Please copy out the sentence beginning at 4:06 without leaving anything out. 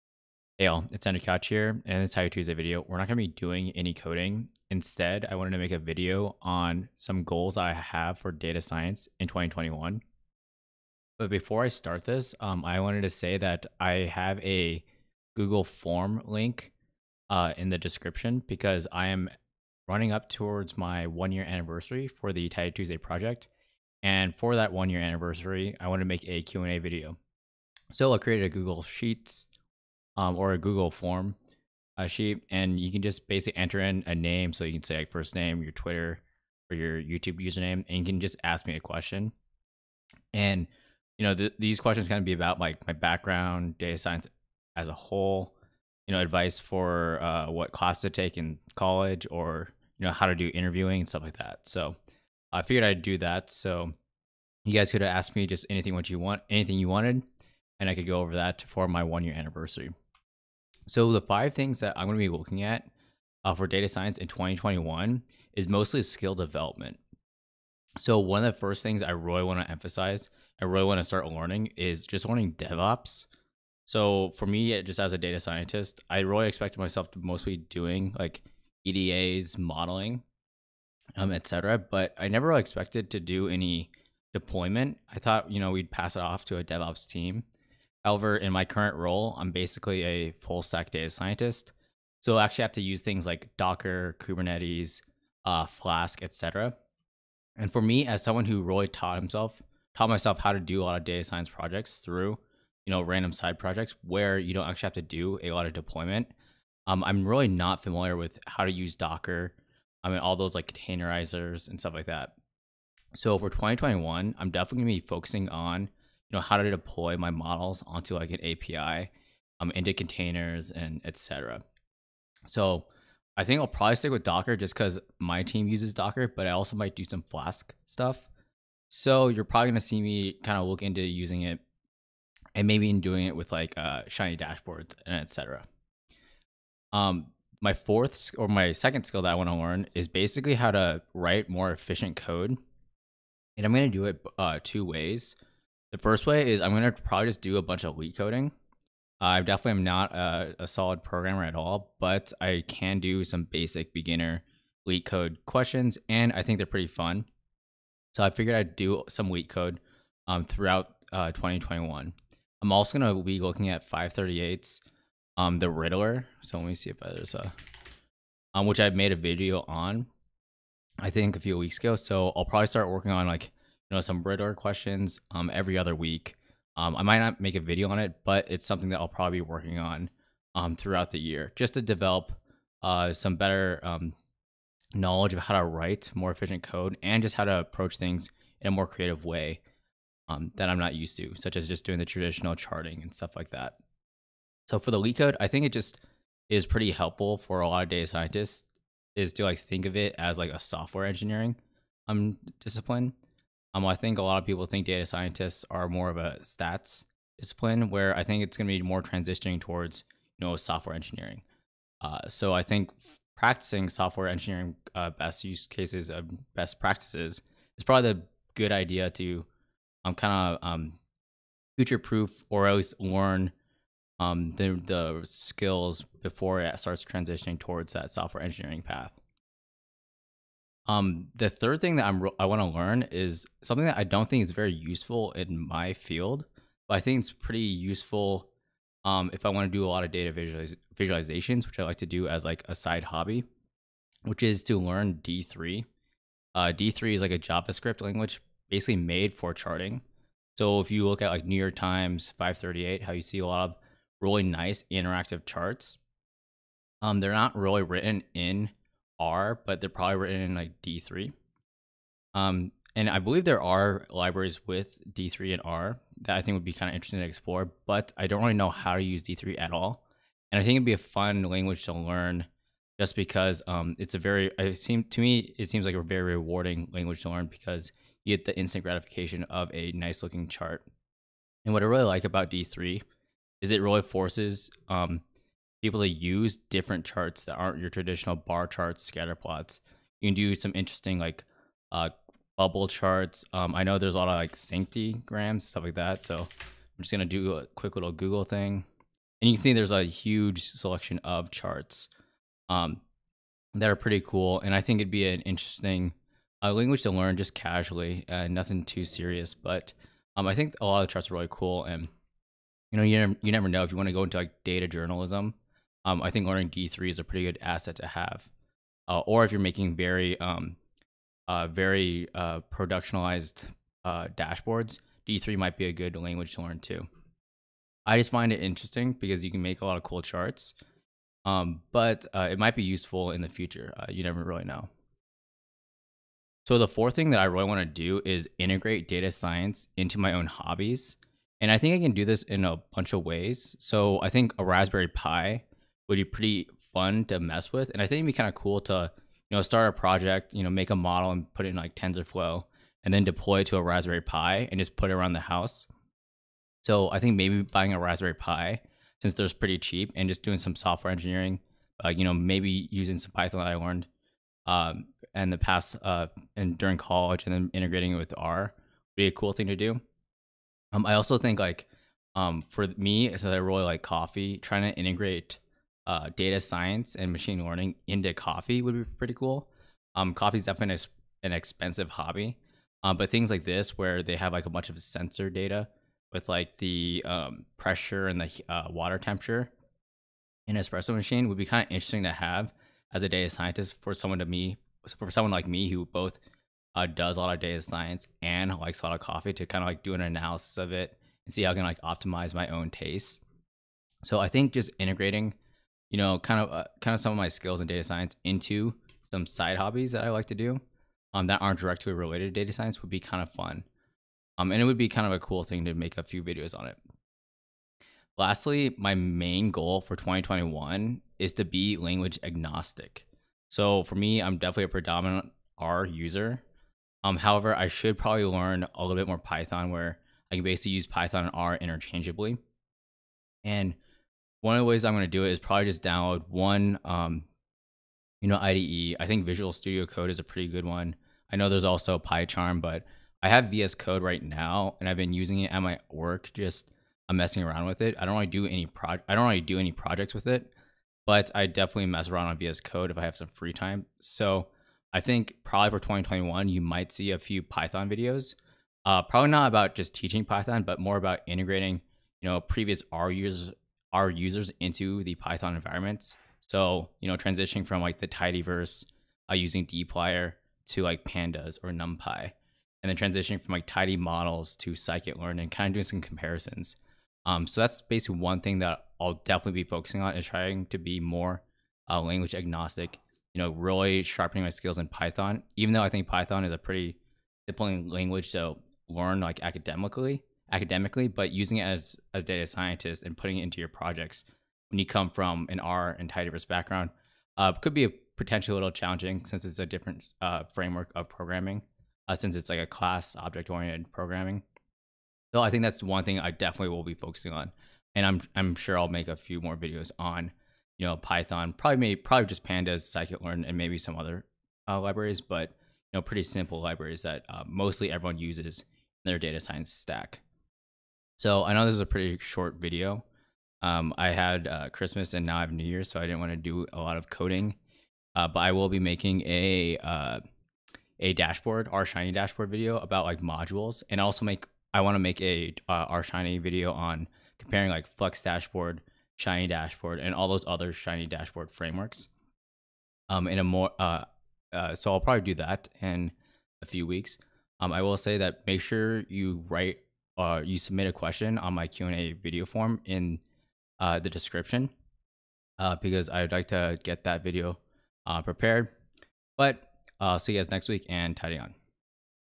Uh, D3 is like a JavaScript language basically made for charting.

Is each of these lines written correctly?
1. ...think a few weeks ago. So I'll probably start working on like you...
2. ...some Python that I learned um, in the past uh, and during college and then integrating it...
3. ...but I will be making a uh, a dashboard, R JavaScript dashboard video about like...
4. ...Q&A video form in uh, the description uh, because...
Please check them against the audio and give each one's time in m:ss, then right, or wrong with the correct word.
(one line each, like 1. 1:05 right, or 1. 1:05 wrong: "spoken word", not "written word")
1. 2:51 right
2. 6:03 right
3. 8:48 wrong: "Shiny", not "JavaScript"
4. 9:11 right.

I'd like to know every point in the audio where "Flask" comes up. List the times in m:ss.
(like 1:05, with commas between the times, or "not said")
1:35, 2:07.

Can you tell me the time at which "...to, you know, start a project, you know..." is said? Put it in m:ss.
5:48.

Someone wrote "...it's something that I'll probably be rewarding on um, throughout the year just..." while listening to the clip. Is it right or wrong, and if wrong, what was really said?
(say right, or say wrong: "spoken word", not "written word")
wrong: "working", not "rewarding".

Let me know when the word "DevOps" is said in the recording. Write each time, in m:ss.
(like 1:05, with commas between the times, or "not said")
1:12, 1:26.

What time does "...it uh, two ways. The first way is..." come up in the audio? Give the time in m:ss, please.
2:24.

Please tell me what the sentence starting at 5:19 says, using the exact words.
Uh, or if you're making very, um, uh, very uh, productionalized uh, dashboards, D3 might be a good language to learn too.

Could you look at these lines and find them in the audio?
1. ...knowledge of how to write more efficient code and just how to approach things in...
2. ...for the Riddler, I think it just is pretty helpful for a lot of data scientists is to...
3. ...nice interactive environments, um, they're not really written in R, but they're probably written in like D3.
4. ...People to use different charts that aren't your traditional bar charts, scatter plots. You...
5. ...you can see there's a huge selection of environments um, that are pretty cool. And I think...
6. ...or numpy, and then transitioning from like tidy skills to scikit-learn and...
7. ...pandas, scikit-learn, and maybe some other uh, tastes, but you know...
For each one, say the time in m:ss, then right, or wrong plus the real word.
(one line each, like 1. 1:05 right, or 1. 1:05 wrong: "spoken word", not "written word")
1. 3:04 right
2. 3:14 wrong: "LeetCode", not "Riddler"
3. 4:14 wrong: "charts", not "environments"
4. 4:45 right
5. 4:59 wrong: "charts", not "environments"
6. 7:51 wrong: "models", not "skills"
7. 8:32 wrong: "libraries", not "tastes".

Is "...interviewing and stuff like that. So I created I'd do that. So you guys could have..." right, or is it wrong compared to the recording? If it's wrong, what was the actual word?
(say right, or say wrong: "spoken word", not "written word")
wrong: "figured", not "created".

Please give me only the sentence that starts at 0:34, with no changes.
So you can say like first name, your Twitter, or your YouTube username, and you can just ask me a question.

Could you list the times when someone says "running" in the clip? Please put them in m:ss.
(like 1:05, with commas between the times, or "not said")
0:19.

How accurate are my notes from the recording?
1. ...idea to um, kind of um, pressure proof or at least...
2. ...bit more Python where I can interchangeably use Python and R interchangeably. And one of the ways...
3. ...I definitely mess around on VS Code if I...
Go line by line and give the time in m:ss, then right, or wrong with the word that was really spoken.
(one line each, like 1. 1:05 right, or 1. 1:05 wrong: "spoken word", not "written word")
1. 3:38 wrong: "future", not "pressure"
2. 7:09 wrong: "basically", not "interchangeably"
3. 7:31 right.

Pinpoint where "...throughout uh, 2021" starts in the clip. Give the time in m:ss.
2:40.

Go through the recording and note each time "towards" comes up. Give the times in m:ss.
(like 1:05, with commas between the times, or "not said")
0:20, 3:29, 3:47.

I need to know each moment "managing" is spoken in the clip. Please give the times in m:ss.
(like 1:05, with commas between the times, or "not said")
not said.